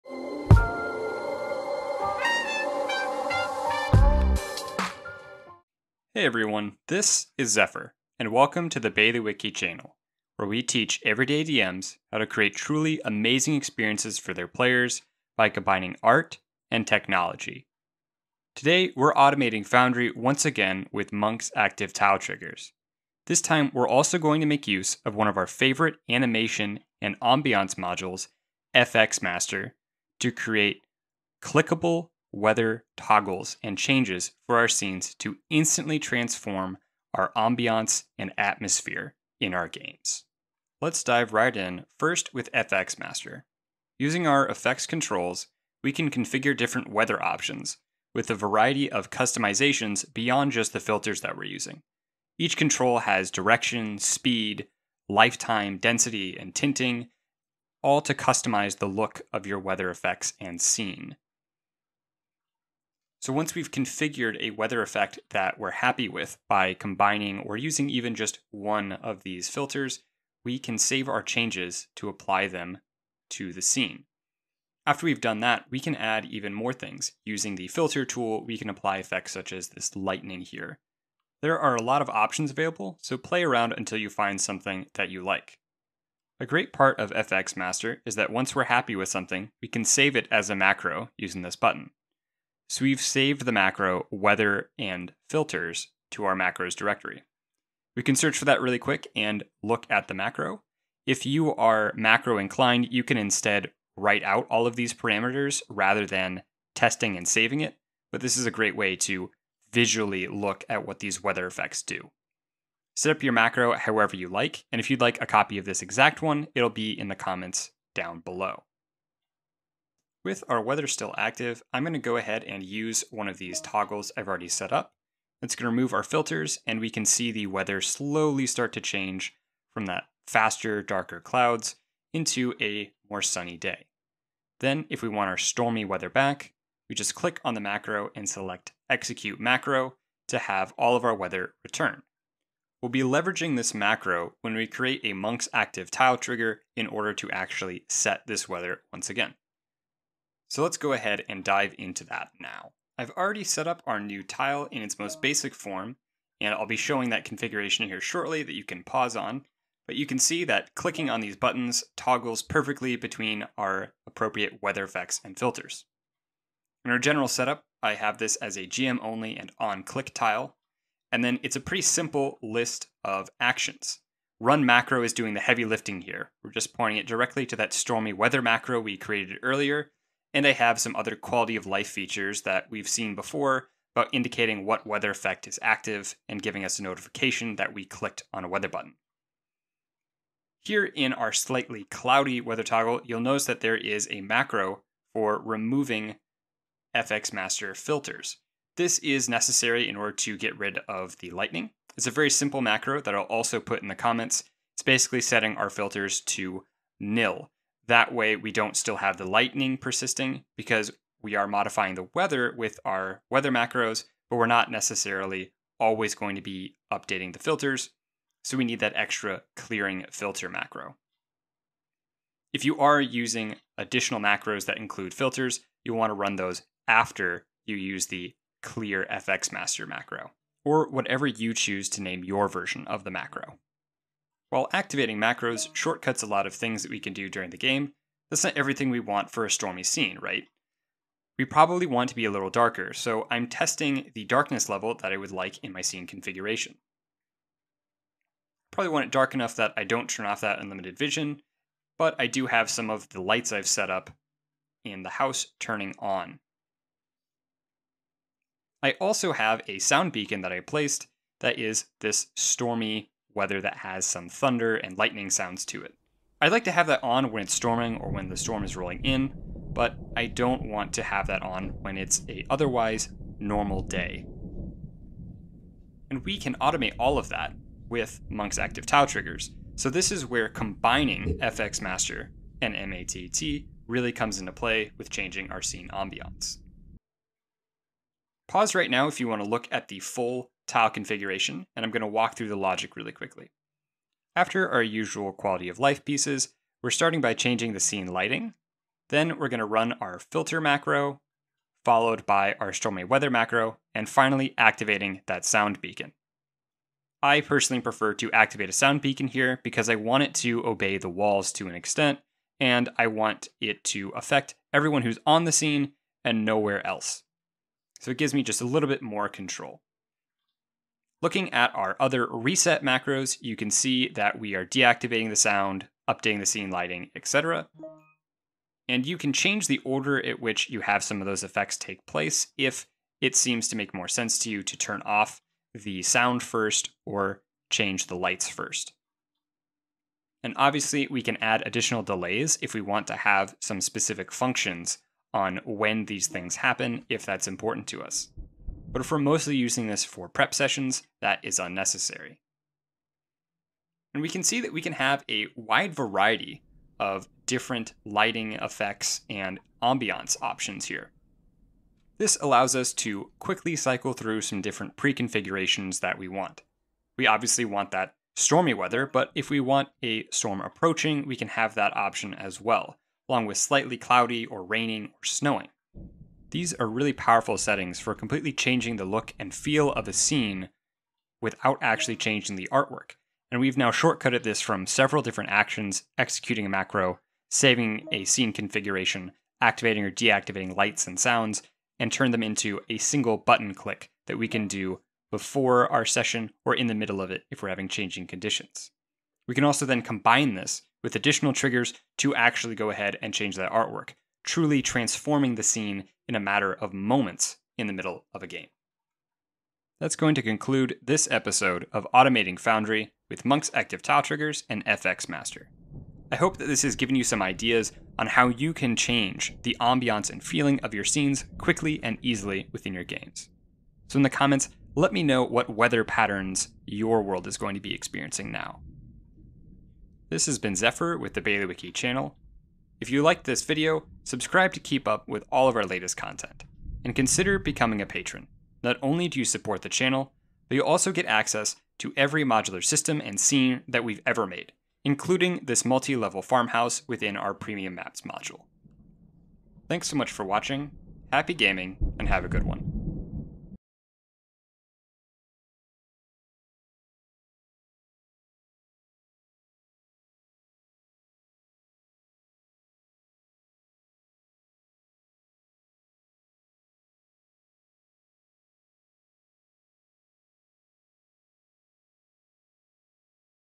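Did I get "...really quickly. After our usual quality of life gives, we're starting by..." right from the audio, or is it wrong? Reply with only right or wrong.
wrong.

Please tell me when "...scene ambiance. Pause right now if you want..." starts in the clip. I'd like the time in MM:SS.
04:45.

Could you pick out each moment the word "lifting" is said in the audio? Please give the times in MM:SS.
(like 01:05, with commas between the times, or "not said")
02:55.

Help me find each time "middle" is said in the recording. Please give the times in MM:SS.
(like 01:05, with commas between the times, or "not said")
06:36, 06:47.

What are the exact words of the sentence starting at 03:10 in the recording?
Here in our slightly cloudy weather toggle, you'll notice that there is a macro for removing FX Master filters.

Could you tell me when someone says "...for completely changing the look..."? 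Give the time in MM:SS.
06:18.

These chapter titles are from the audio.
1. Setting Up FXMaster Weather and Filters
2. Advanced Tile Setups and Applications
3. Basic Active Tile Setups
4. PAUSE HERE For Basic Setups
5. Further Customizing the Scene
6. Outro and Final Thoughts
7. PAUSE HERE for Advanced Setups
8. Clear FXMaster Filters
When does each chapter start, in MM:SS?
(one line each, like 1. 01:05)
1. 00:40
2. 05:28
3. 02:33
4. 02:44
5. 03:50
6. 06:49
7. 04:46
8. 03:15.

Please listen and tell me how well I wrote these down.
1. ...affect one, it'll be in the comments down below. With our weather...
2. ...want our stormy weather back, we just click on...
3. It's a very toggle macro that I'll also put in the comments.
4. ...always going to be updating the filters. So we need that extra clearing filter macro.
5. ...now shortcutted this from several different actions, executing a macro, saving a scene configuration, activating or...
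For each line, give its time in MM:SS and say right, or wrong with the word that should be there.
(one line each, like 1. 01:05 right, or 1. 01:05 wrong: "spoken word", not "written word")
1. 01:55 wrong: "exact", not "affect"
2. 02:15 right
3. 03:21 wrong: "simple", not "toggle"
4. 03:35 right
5. 06:23 right.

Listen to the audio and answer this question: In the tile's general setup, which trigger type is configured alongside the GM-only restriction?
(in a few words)
on click tile.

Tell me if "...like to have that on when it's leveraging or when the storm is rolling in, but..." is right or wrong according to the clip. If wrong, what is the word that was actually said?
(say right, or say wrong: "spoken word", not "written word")
wrong: "storming", not "leveraging".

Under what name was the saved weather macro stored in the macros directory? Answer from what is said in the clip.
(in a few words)
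weather and filters.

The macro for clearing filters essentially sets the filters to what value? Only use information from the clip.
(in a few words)
nil.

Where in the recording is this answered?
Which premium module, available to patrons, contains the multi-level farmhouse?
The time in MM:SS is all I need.
07:27.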